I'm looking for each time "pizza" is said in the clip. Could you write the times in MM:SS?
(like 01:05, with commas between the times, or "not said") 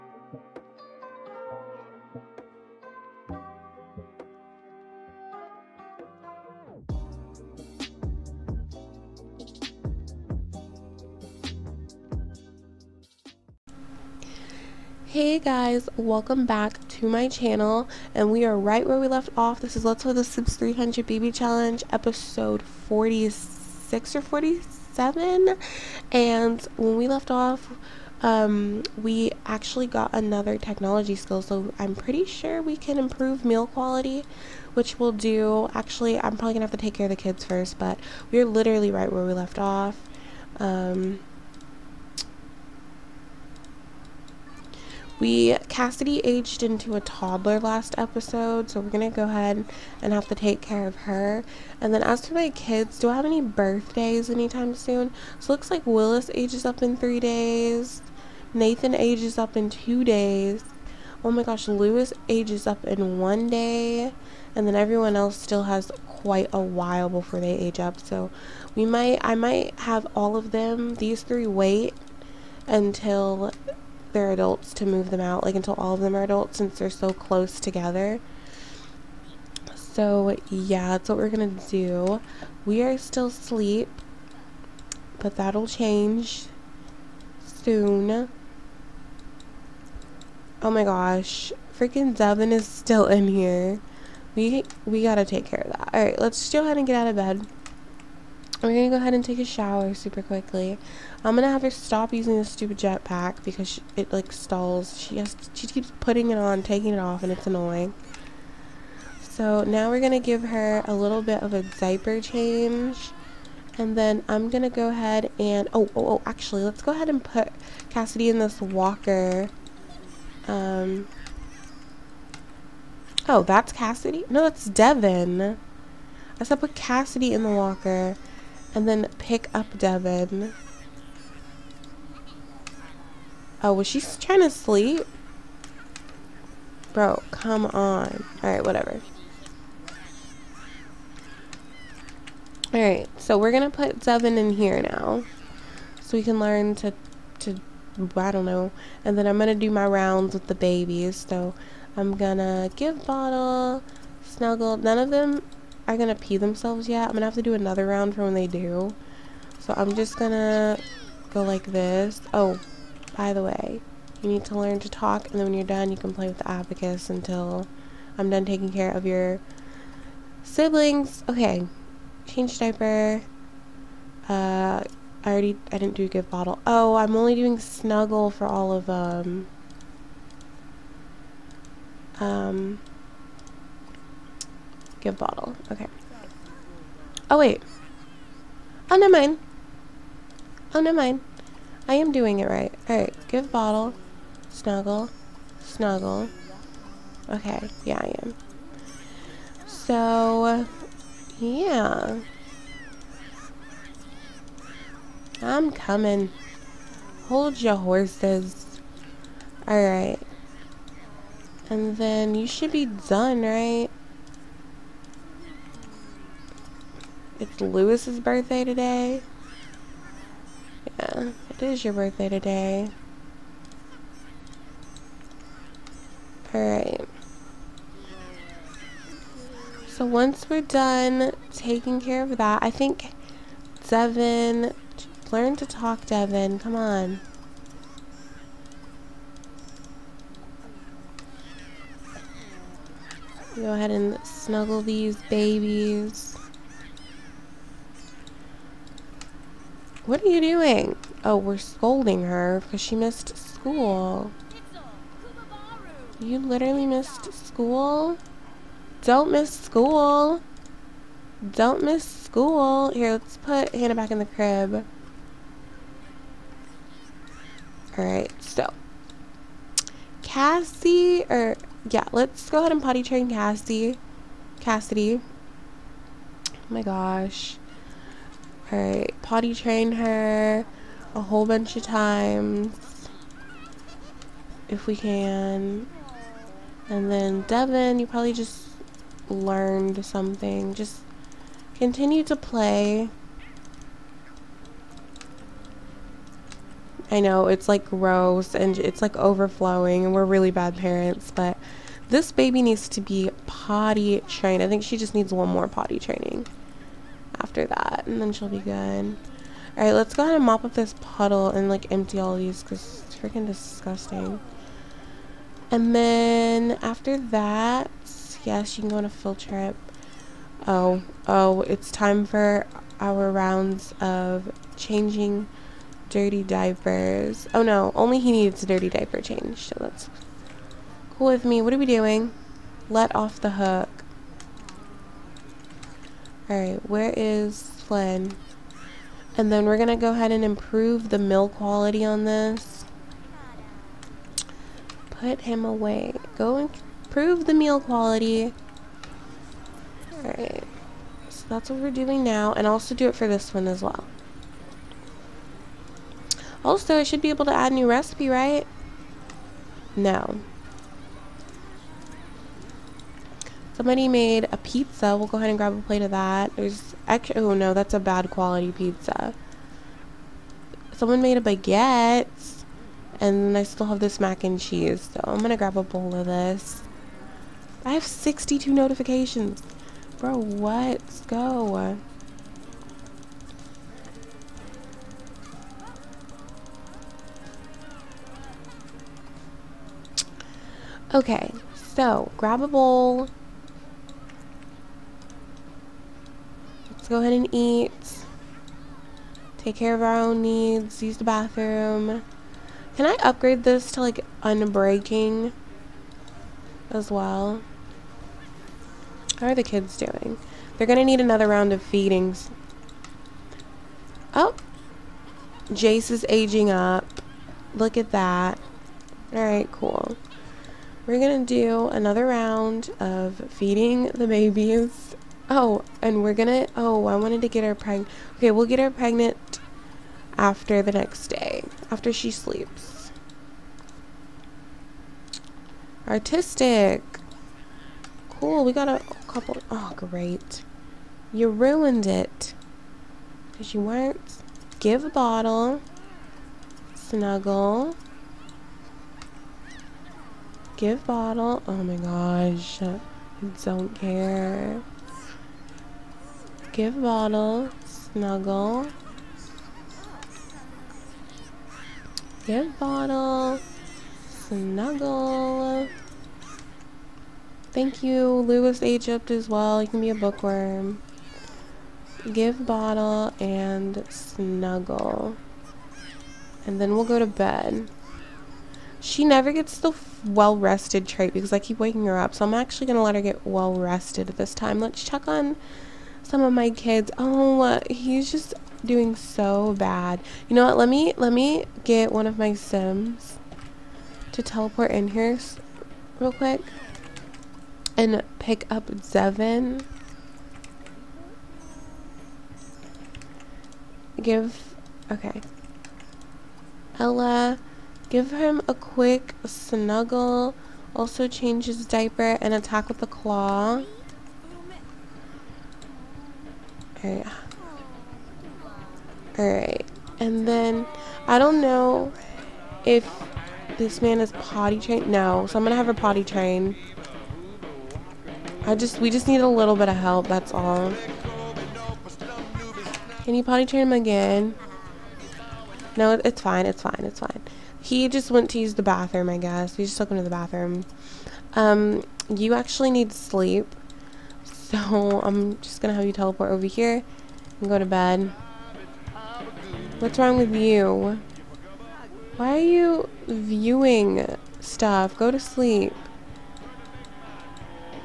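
06:04, 06:08.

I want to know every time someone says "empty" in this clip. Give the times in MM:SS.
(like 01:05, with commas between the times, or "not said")
05:11.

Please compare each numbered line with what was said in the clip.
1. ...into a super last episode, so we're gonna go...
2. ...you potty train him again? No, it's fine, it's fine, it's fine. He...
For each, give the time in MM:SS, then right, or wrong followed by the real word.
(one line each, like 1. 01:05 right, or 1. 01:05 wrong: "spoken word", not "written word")
1. 00:46 wrong: "toddler", not "super"
2. 08:53 right.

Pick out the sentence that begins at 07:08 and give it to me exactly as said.
Okay, we'll get her pregnant after the next day, after she sleeps.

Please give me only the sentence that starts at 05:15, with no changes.
And then, after that, yes, you can go on a field trip.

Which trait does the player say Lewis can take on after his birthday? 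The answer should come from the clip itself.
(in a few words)
bookworm.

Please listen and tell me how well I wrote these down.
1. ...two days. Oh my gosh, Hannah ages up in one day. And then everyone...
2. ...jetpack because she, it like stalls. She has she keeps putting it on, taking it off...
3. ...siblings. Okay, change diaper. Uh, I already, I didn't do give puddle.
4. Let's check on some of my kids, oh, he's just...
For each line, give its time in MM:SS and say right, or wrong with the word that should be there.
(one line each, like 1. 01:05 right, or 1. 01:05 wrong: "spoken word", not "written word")
1. 00:59 wrong: "Lewis", not "Hannah"
2. 01:42 right
3. 02:50 wrong: "bottle", not "puddle"
4. 08:04 right.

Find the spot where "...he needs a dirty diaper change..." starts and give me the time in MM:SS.
05:28.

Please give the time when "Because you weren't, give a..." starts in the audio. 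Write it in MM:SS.
07:23.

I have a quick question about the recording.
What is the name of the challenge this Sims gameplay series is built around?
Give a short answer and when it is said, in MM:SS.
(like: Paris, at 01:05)
300 BB Challenge, at 00:20.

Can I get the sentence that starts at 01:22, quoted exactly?
We are still asleep, but that'll change soon.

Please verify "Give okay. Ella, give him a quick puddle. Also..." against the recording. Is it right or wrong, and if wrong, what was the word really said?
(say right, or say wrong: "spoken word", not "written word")
wrong: "snuggle", not "puddle".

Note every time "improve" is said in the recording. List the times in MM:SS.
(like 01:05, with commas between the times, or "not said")
00:32, 05:40, 05:47.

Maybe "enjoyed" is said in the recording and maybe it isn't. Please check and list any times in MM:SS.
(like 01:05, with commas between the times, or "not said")
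not said.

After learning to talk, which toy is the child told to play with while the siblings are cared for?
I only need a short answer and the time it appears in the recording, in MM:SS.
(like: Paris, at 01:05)
abacus, at 02:46.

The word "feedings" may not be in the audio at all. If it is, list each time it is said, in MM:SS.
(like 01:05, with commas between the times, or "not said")
06:51, 07:03.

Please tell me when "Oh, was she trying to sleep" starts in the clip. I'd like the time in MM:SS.
02:13.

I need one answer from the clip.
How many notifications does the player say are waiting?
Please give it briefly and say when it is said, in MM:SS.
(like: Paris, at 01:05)
62, at 06:18.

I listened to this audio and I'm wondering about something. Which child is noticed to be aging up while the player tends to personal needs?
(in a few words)
Jace.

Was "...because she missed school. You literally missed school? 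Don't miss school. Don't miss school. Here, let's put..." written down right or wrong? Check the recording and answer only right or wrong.
right.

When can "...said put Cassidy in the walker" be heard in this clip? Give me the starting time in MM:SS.
02:06.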